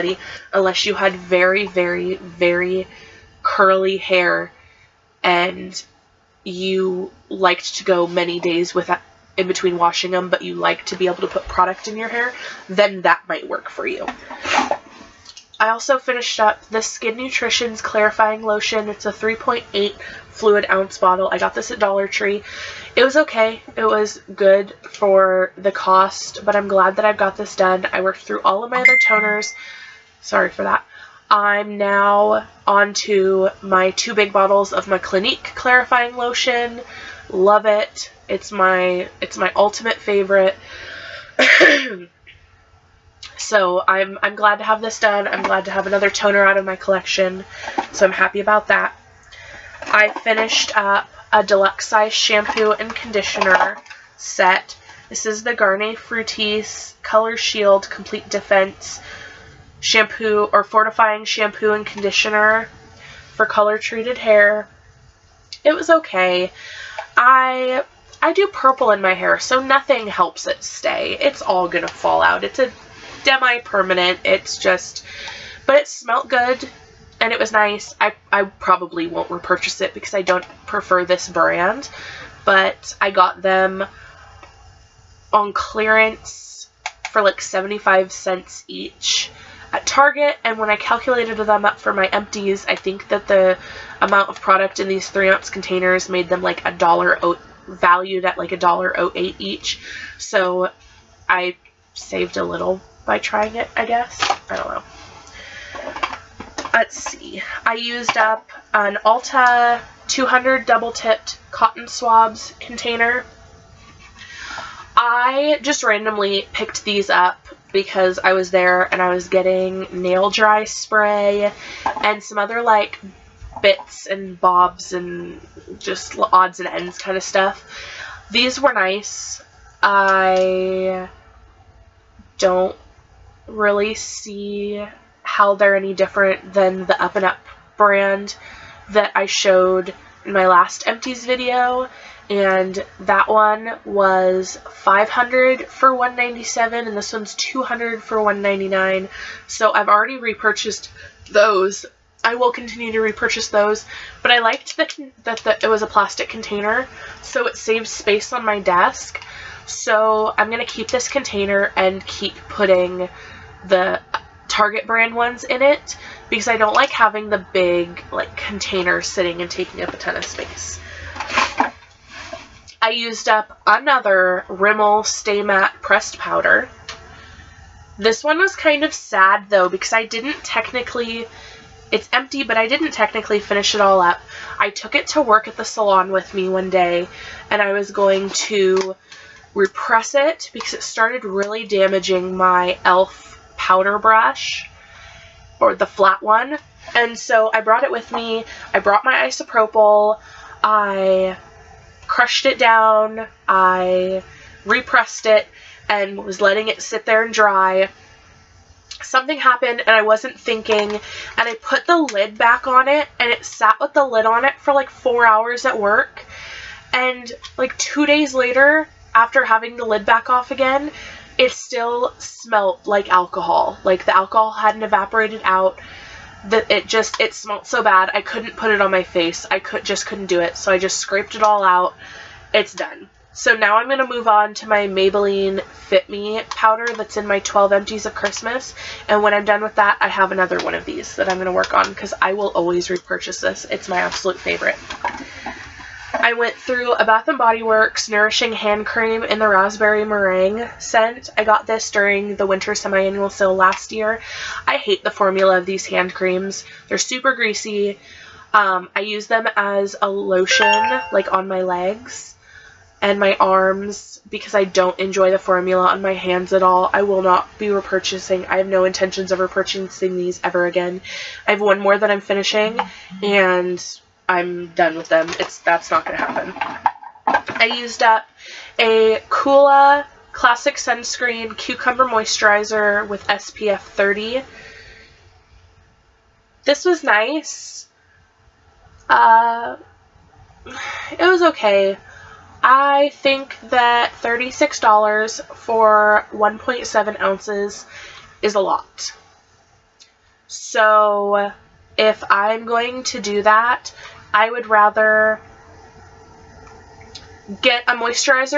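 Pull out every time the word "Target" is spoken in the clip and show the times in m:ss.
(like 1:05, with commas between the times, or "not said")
1:29, 2:44.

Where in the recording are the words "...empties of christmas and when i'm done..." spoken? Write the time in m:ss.
3:57.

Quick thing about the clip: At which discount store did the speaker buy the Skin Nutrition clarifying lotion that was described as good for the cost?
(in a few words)
Dollar Tree.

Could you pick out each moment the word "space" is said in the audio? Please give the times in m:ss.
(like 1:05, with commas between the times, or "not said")
2:37, 2:50.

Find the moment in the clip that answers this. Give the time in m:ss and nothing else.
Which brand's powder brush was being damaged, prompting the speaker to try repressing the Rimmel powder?
3:12.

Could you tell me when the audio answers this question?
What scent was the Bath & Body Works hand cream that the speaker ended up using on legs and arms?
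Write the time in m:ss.
4:09.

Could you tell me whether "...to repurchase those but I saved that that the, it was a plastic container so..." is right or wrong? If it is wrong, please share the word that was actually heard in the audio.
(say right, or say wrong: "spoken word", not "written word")
wrong: "liked", not "saved".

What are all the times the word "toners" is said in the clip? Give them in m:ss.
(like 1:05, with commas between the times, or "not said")
0:29, 0:46.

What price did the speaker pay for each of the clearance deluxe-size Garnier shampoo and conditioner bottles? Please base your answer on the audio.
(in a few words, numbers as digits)
75 cents.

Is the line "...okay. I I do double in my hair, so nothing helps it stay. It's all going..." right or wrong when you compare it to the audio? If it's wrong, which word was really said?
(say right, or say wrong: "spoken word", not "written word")
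wrong: "purple", not "double".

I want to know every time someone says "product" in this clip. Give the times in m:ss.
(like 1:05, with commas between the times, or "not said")
0:11, 1:34.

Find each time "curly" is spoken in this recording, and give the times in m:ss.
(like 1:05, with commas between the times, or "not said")
0:03.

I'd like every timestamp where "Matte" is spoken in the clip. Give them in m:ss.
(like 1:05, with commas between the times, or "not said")
2:55.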